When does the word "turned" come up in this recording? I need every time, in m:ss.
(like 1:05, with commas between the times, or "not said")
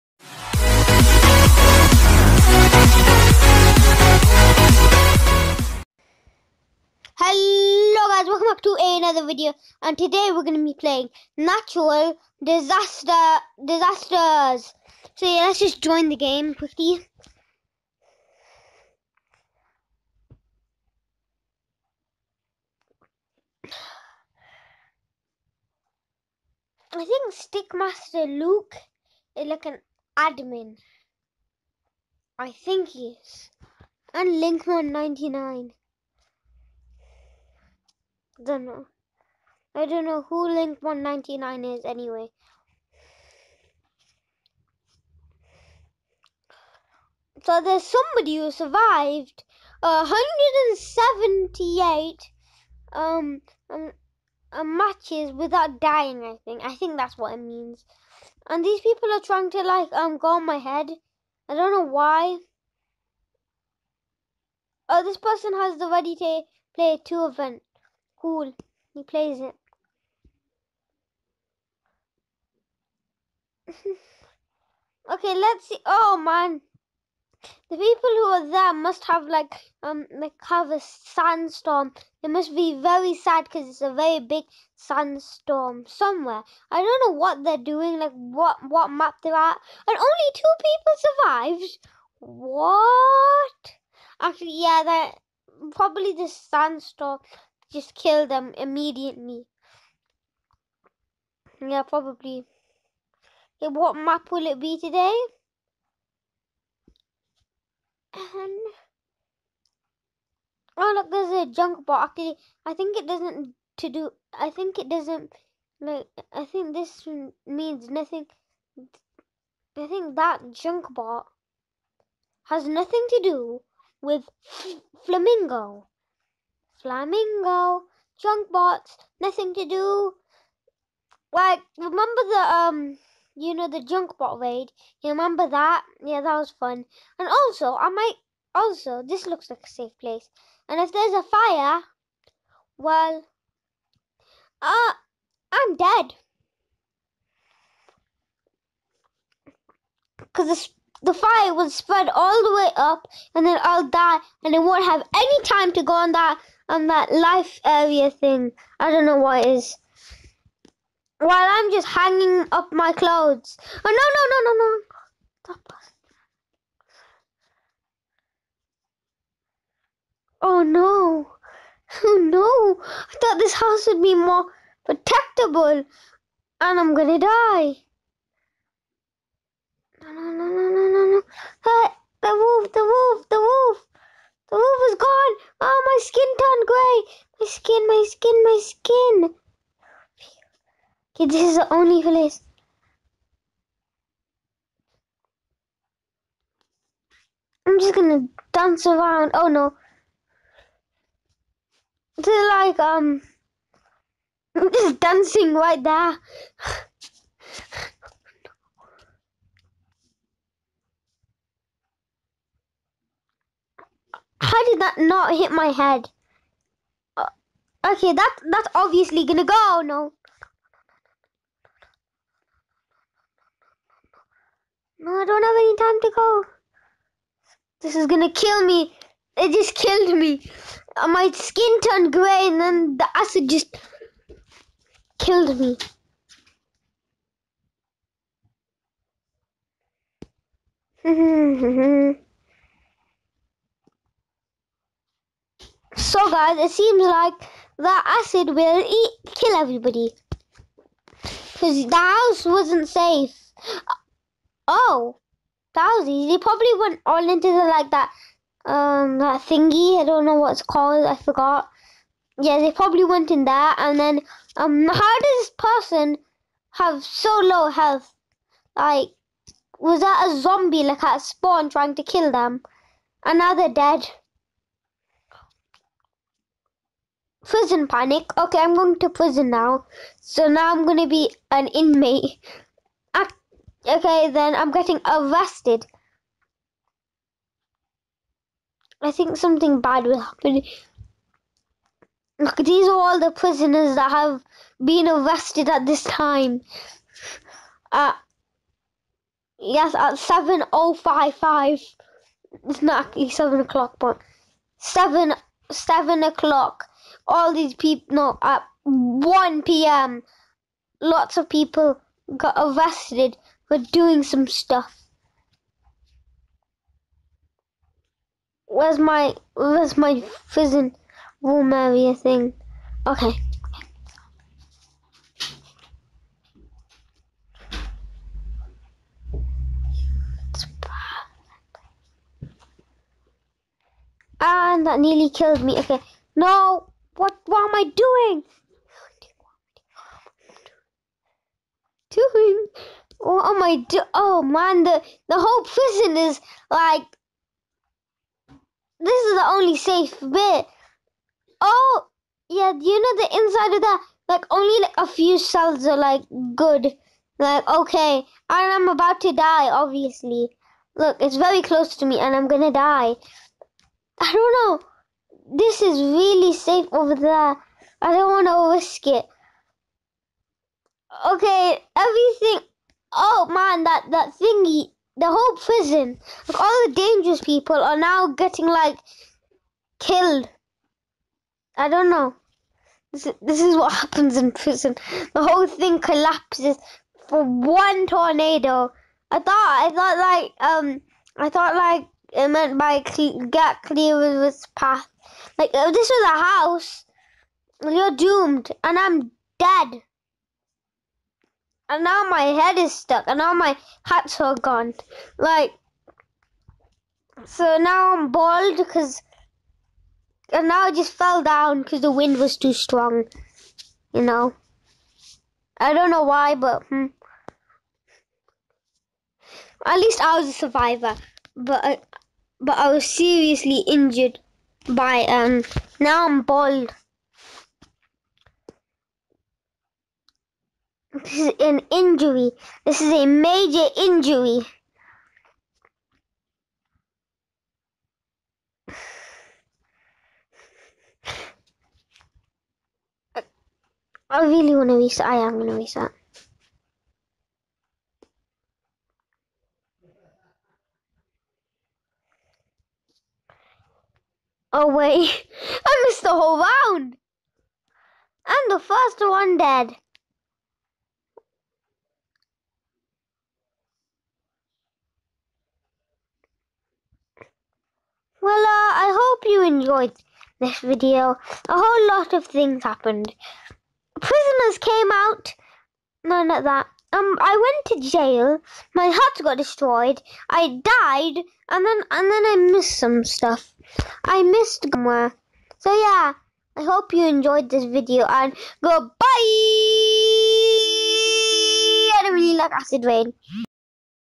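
3:06, 3:51.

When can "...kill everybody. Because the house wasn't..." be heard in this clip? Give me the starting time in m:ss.
4:09.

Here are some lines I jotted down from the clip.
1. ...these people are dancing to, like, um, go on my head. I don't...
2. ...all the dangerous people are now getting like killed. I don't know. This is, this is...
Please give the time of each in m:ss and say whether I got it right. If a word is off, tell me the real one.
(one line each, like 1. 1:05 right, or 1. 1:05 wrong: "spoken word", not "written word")
1. 0:58 wrong: "trying", not "dancing"
2. 6:16 right.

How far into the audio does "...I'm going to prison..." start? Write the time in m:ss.
4:38.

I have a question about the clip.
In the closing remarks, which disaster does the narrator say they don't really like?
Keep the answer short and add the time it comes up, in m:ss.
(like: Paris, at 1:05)
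Acid rain, at 8:12.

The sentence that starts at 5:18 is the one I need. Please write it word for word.
Where's my where's my fizzing room area thing?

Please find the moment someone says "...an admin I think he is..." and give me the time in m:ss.
0:29.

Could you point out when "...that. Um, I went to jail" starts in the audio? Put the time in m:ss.
7:56.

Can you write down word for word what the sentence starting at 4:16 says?
Probably went on into the like that um that thingy.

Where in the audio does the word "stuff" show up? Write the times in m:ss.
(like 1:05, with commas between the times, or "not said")
5:14, 8:03.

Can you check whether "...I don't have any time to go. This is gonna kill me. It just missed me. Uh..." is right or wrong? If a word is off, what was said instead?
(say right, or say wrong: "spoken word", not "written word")
wrong: "killed", not "missed".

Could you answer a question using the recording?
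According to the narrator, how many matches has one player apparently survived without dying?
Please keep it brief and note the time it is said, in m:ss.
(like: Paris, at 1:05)
178, at 0:49.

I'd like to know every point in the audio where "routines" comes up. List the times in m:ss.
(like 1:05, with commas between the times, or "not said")
not said.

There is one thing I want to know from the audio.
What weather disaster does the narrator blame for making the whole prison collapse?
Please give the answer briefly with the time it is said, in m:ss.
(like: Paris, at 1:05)
Tornado, at 6:28.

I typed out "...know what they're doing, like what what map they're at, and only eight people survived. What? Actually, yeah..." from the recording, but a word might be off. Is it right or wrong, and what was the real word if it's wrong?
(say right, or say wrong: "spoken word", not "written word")
wrong: "two", not "eight".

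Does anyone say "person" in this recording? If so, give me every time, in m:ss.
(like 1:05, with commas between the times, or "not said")
1:05, 4:25.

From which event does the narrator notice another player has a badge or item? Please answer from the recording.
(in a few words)
Ready to Play 2.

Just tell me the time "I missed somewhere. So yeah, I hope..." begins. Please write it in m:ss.
8:04.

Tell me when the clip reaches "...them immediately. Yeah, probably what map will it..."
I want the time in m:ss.
1:38.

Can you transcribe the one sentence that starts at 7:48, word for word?
Well, uh, I hope you enjoyed this video.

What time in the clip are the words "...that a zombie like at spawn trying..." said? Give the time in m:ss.
4:29.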